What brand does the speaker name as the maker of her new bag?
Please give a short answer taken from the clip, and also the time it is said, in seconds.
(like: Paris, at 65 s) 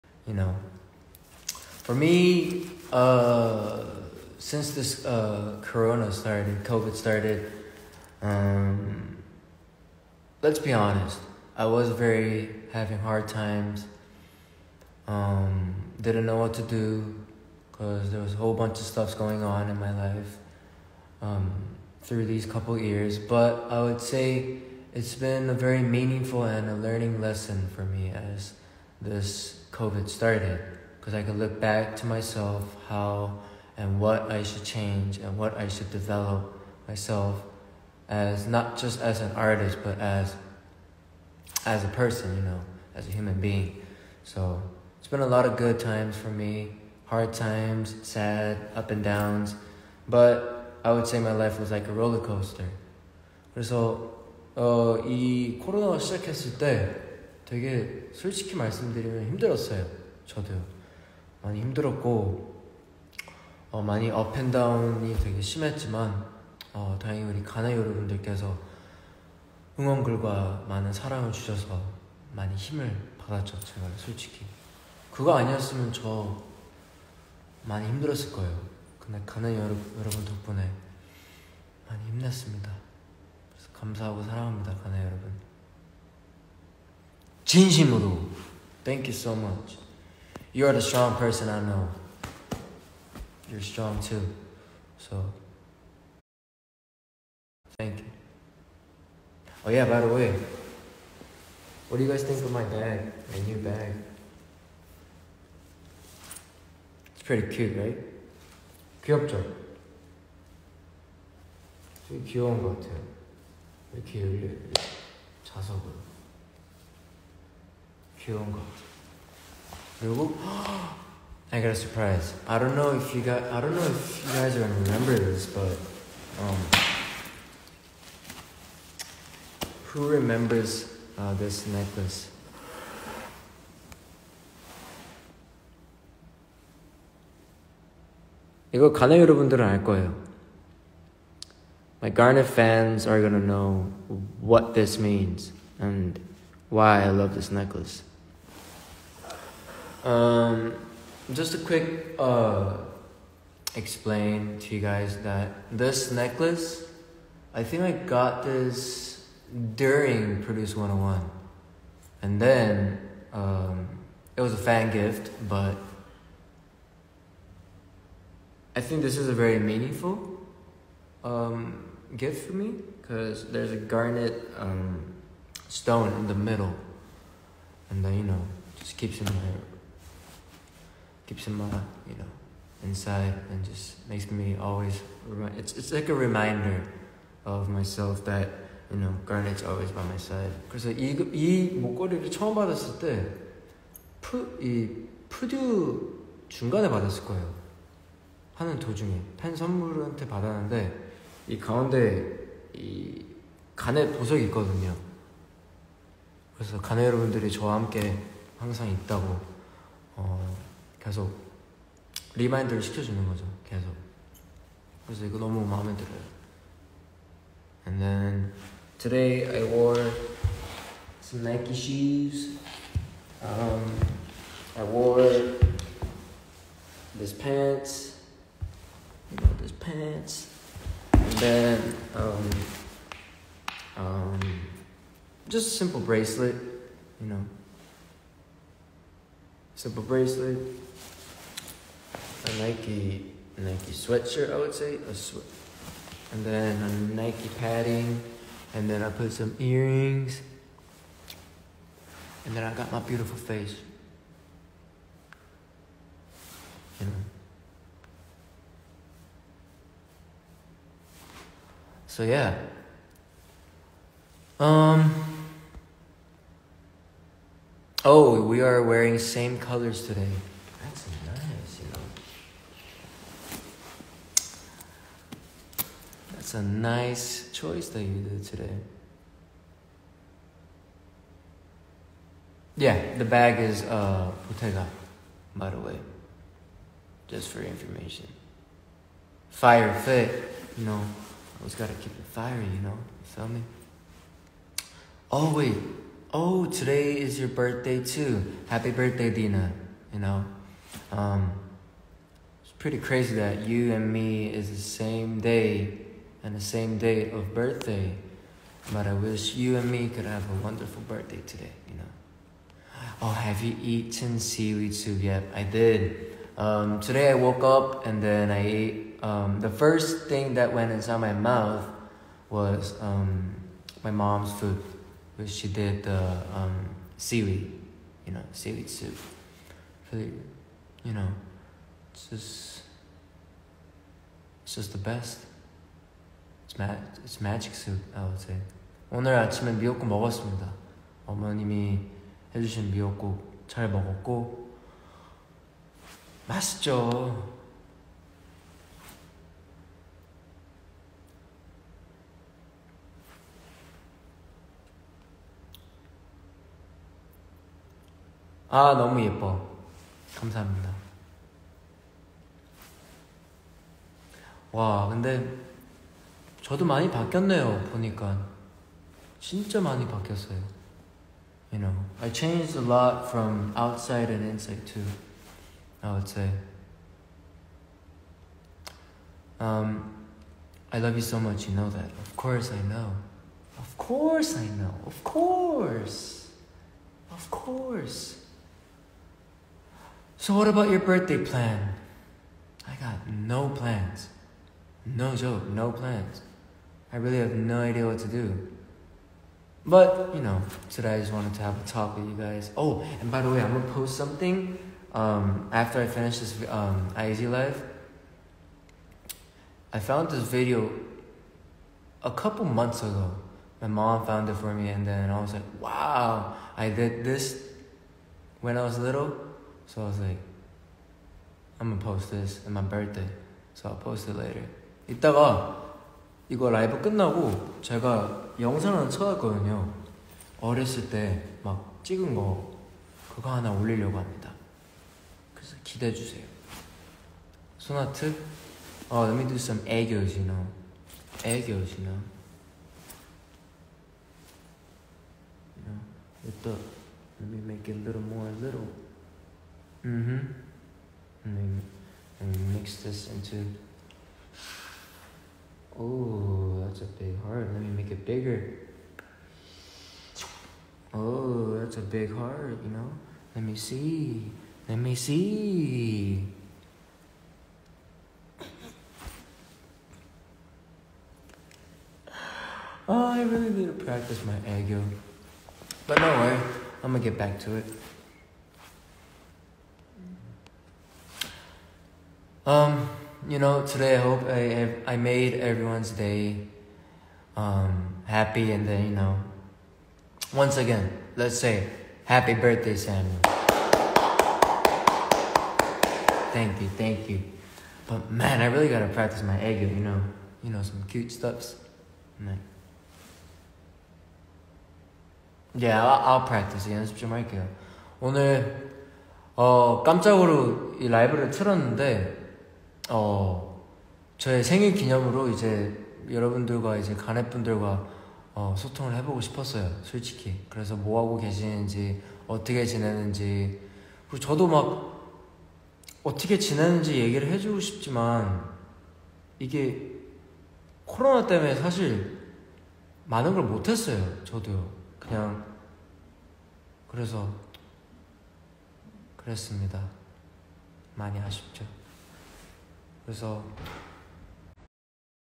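Bottega, at 284 s.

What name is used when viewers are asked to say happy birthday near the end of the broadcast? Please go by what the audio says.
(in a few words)
Samuel.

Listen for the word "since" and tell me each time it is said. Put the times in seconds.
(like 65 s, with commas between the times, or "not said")
4 s.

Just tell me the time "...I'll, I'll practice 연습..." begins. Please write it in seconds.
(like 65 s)
506 s.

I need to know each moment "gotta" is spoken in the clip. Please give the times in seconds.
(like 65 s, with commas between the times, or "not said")
291 s, 498 s.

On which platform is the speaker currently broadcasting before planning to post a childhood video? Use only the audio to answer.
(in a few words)
IG Live.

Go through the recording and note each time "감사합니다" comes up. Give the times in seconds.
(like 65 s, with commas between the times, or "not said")
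360 s.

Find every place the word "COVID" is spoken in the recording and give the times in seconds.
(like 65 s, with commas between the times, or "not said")
6 s, 29 s.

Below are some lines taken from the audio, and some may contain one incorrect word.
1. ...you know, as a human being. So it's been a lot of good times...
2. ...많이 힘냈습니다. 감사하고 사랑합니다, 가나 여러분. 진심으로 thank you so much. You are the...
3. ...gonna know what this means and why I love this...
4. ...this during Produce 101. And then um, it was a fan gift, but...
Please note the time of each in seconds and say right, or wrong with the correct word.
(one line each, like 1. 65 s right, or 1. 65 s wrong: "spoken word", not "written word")
1. 42 s right
2. 81 s right
3. 143 s right
4. 158 s right.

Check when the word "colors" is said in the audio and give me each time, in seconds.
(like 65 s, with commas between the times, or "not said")
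269 s.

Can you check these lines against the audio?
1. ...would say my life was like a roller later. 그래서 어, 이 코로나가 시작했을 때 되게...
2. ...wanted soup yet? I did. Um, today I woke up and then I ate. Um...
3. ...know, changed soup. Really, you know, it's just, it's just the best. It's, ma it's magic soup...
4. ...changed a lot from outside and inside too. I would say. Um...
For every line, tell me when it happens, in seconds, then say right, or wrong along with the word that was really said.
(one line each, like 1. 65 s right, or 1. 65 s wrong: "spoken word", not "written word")
1. 50 s wrong: "coaster", not "later"
2. 314 s wrong: "seaweed", not "wanted"
3. 328 s wrong: "seaweed", not "changed"
4. 372 s right.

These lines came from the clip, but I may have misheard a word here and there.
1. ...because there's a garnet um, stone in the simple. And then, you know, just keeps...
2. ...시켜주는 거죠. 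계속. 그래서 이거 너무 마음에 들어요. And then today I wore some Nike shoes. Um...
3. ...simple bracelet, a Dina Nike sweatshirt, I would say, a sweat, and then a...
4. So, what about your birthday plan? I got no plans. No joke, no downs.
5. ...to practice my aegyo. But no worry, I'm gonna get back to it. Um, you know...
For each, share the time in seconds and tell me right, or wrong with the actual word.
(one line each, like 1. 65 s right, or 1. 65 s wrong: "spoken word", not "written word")
1. 173 s wrong: "middle", not "simple"
2. 212 s right
3. 239 s wrong: "Nike", not "Dina"
4. 390 s wrong: "plans", not "downs"
5. 473 s right.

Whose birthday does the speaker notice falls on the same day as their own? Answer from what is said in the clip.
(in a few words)
Dina.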